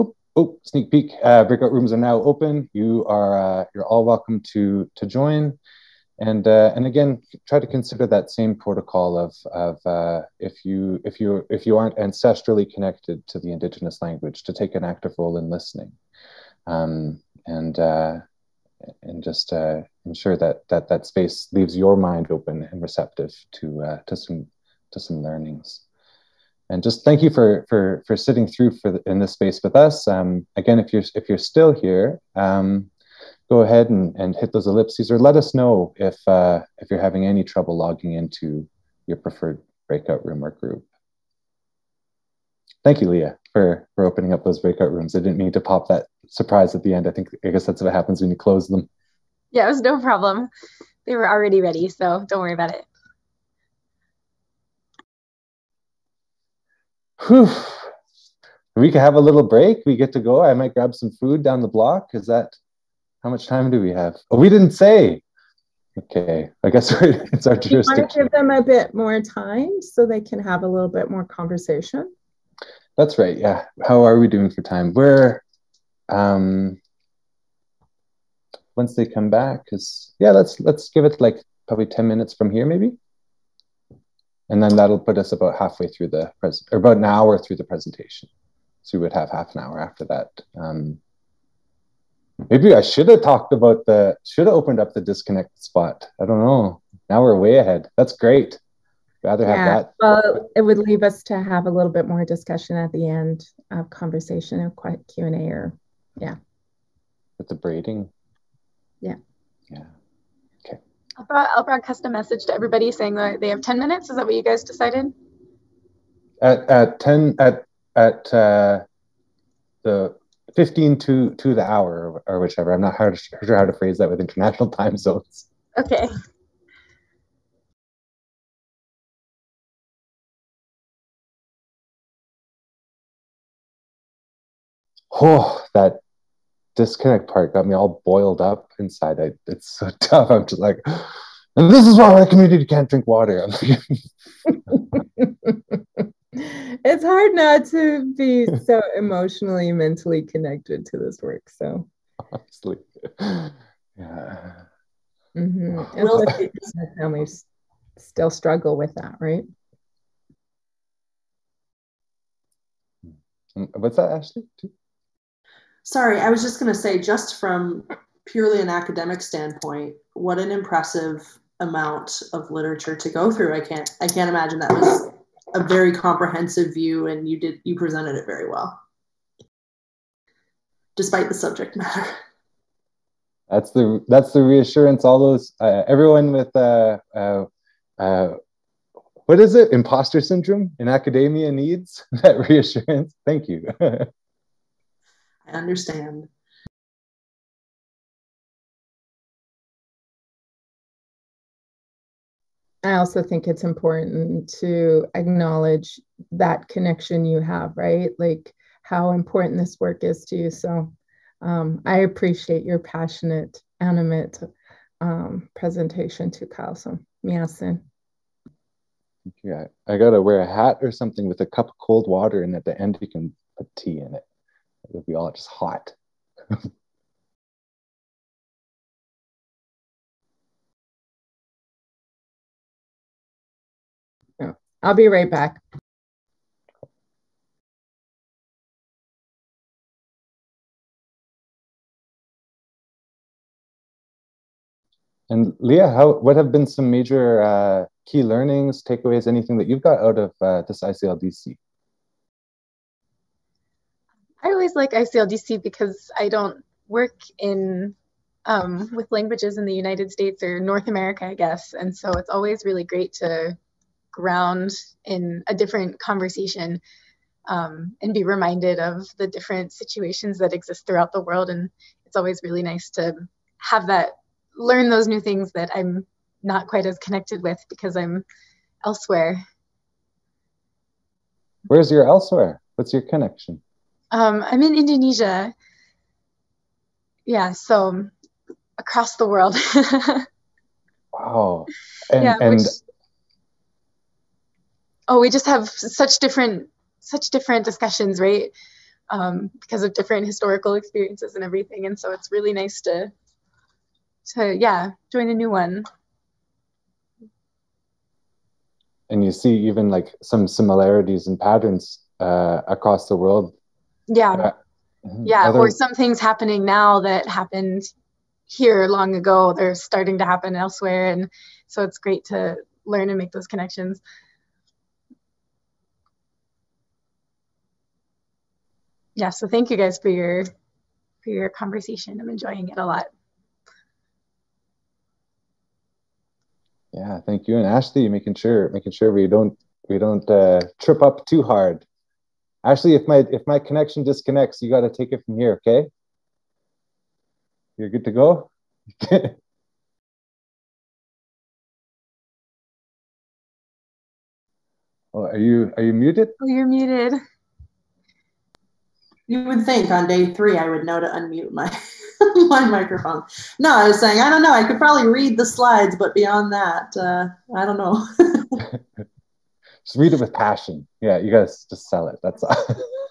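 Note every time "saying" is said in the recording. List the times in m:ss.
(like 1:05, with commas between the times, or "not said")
1:52, 6:03.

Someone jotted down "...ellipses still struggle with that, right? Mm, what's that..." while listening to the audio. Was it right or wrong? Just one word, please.
wrong.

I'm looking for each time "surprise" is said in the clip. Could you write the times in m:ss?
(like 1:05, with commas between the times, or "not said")
0:46.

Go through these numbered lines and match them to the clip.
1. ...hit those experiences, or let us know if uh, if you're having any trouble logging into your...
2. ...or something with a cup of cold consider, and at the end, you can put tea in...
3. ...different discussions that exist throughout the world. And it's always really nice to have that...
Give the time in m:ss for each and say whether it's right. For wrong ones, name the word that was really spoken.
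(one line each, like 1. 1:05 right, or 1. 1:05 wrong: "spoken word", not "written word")
1. 0:34 wrong: "ellipses", not "experiences"
2. 3:40 wrong: "water", not "consider"
3. 4:29 wrong: "situations", not "discussions".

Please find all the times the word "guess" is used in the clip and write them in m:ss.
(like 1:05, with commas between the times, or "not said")
0:47, 1:06, 4:21.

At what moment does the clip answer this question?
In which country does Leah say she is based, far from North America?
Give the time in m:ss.
4:44.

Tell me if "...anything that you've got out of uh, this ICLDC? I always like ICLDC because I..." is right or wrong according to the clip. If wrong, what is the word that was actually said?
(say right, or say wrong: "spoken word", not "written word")
right.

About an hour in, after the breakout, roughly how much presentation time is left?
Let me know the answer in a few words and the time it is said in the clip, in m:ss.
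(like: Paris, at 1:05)
half an hour, at 1:29.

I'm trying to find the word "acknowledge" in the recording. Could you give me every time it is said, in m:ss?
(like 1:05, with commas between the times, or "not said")
3:25.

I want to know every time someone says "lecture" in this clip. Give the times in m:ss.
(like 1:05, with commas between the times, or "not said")
not said.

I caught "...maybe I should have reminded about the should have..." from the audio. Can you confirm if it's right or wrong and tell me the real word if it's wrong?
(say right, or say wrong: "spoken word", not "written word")
wrong: "talked", not "reminded".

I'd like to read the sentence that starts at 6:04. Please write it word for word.
I could probably read the slides, but beyond that, uh, I don't know.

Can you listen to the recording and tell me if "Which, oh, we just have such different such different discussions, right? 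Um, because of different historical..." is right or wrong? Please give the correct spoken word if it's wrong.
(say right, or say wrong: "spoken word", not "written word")
right.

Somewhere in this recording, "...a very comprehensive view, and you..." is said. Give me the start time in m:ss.
2:55.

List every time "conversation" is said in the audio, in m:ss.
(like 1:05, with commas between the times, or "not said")
1:11, 1:43, 4:25, 5:31.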